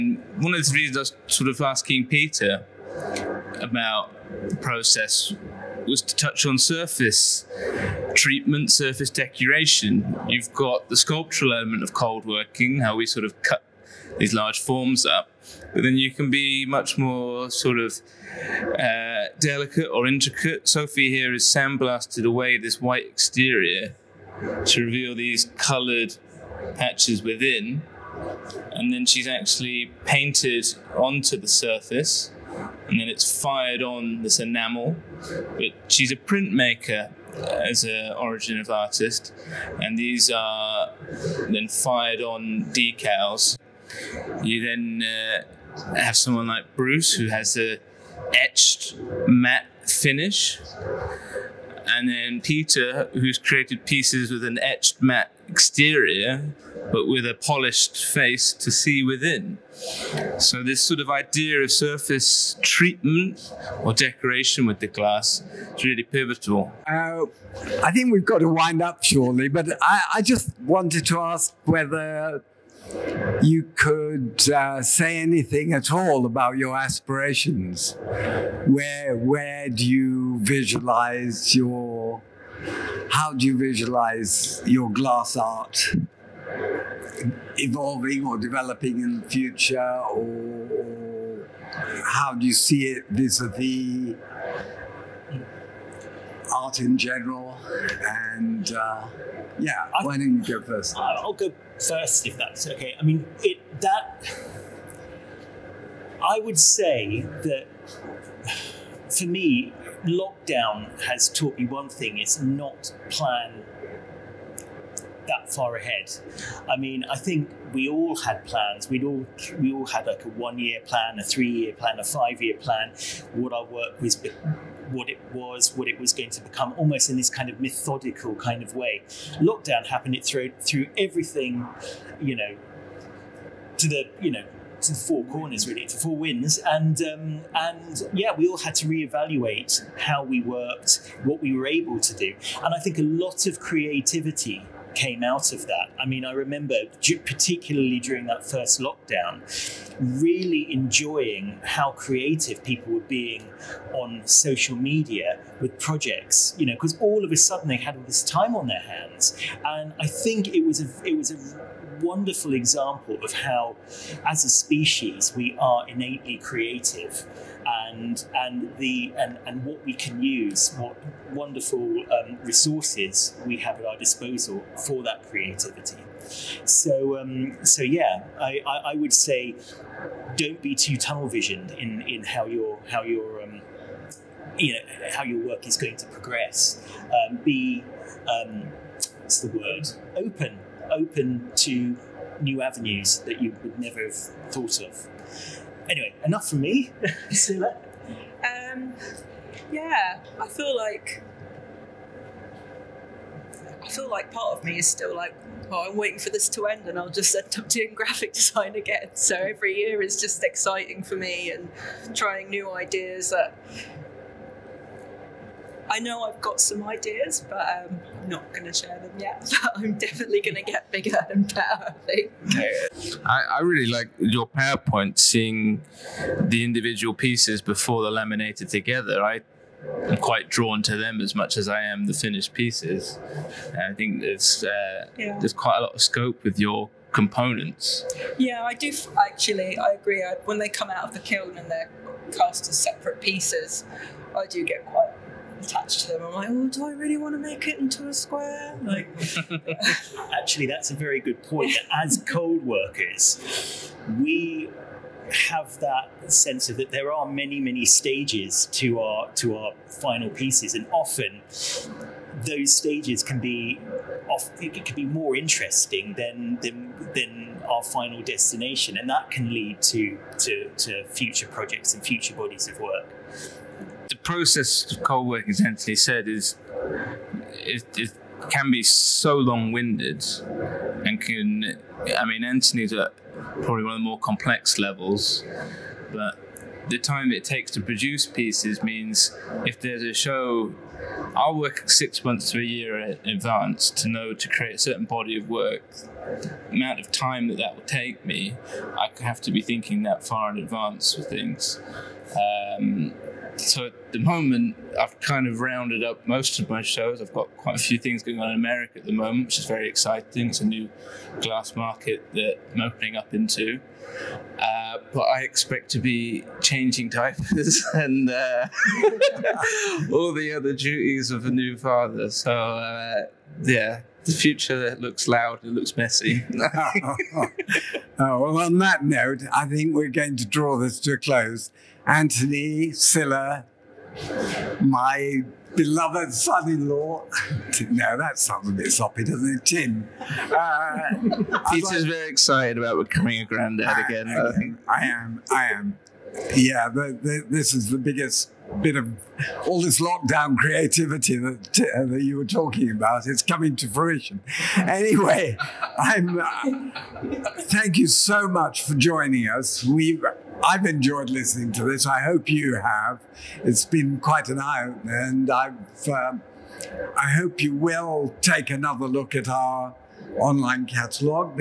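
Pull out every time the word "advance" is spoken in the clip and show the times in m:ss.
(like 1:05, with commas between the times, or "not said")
4:53, 5:00.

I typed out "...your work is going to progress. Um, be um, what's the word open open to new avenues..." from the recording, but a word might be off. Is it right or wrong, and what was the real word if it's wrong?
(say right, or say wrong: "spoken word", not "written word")
right.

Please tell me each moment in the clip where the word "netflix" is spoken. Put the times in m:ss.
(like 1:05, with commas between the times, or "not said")
not said.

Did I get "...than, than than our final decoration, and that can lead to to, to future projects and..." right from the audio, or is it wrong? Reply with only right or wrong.
wrong.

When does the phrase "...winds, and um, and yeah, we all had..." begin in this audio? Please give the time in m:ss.
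2:16.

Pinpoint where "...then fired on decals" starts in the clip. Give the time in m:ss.
0:41.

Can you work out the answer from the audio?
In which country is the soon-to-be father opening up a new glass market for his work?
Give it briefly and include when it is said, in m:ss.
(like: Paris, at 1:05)
America, at 5:08.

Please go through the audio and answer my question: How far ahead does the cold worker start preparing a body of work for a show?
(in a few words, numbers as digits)
6 months to a year.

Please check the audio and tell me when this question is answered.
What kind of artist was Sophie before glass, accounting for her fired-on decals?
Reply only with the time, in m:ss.
0:36.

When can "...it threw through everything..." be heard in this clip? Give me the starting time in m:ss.
2:10.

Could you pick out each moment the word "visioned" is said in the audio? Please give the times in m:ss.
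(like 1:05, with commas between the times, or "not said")
3:01.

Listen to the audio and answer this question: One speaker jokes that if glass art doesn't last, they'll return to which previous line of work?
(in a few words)
graphic design.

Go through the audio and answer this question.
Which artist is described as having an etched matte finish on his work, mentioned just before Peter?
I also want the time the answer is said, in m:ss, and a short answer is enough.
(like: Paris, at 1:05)
Bruce, at 0:46.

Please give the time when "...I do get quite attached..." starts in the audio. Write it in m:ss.
4:04.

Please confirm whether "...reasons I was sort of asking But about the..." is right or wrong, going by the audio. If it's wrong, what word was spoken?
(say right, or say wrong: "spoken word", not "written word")
wrong: "Peter", not "But".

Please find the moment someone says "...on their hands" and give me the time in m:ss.
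2:38.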